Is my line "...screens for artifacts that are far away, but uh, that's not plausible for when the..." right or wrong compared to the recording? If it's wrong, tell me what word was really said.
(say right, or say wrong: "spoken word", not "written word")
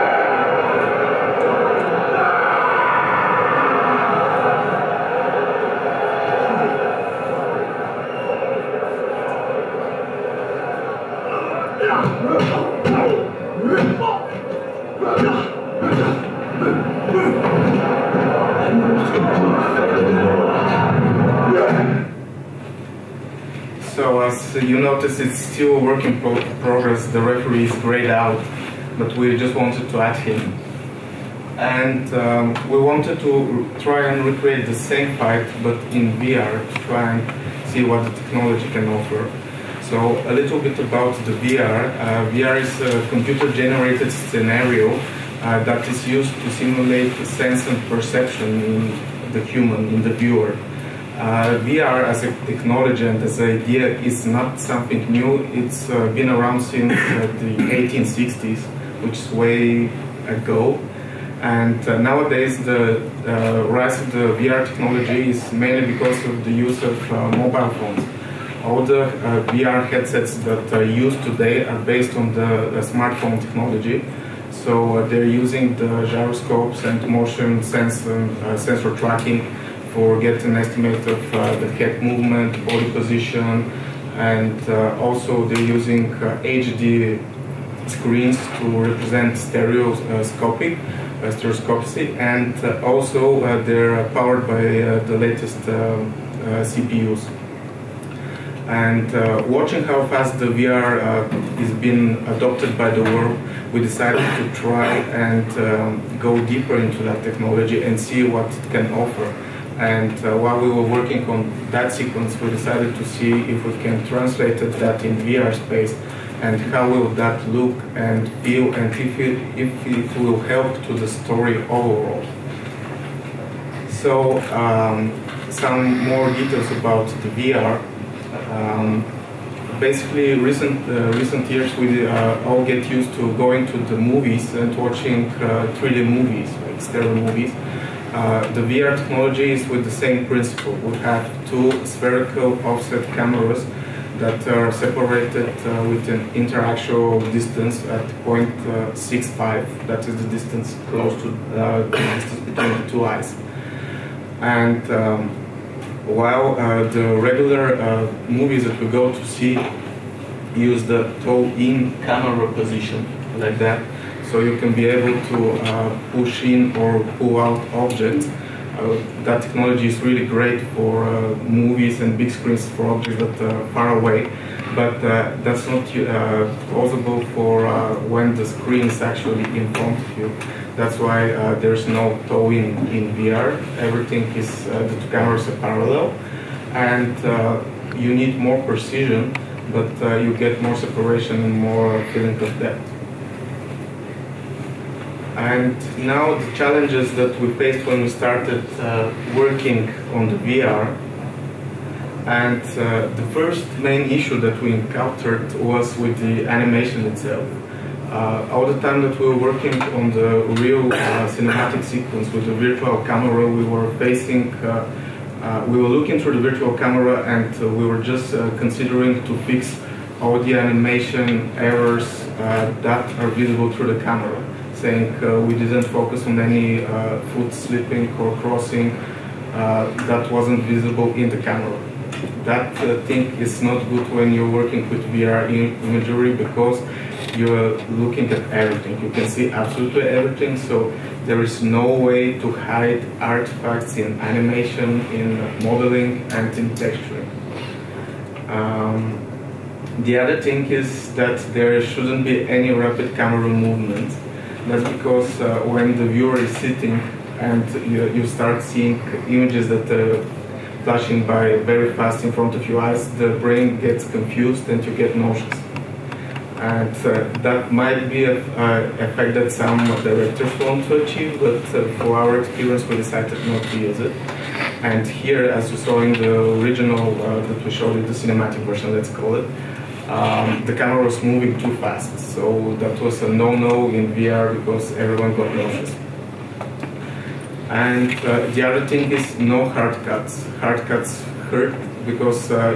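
wrong: "objects", not "artifacts".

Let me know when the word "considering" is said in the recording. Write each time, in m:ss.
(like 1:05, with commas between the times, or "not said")
3:38.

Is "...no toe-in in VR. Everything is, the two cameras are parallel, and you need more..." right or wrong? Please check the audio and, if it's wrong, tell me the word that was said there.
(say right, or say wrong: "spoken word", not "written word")
right.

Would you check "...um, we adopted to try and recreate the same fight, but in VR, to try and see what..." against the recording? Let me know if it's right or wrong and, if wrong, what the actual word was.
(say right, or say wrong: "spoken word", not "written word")
wrong: "wanted", not "adopted".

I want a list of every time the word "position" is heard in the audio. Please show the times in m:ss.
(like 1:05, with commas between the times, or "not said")
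1:22, 2:42.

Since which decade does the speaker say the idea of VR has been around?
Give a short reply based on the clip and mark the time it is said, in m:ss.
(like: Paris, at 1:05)
1860s, at 0:57.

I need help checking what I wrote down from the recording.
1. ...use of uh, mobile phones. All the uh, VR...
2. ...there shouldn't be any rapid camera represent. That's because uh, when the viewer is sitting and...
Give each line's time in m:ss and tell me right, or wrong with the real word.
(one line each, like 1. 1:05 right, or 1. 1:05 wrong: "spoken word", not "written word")
1. 1:06 right
2. 4:11 wrong: "movement", not "represent".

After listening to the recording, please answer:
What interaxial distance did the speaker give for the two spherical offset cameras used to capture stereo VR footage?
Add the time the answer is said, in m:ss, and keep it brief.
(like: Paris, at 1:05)
0.65, at 2:28.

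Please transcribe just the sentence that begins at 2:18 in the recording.
Uh, the VR technology is with the same principle.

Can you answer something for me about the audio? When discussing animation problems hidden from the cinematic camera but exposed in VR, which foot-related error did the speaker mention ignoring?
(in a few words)
foot slipping.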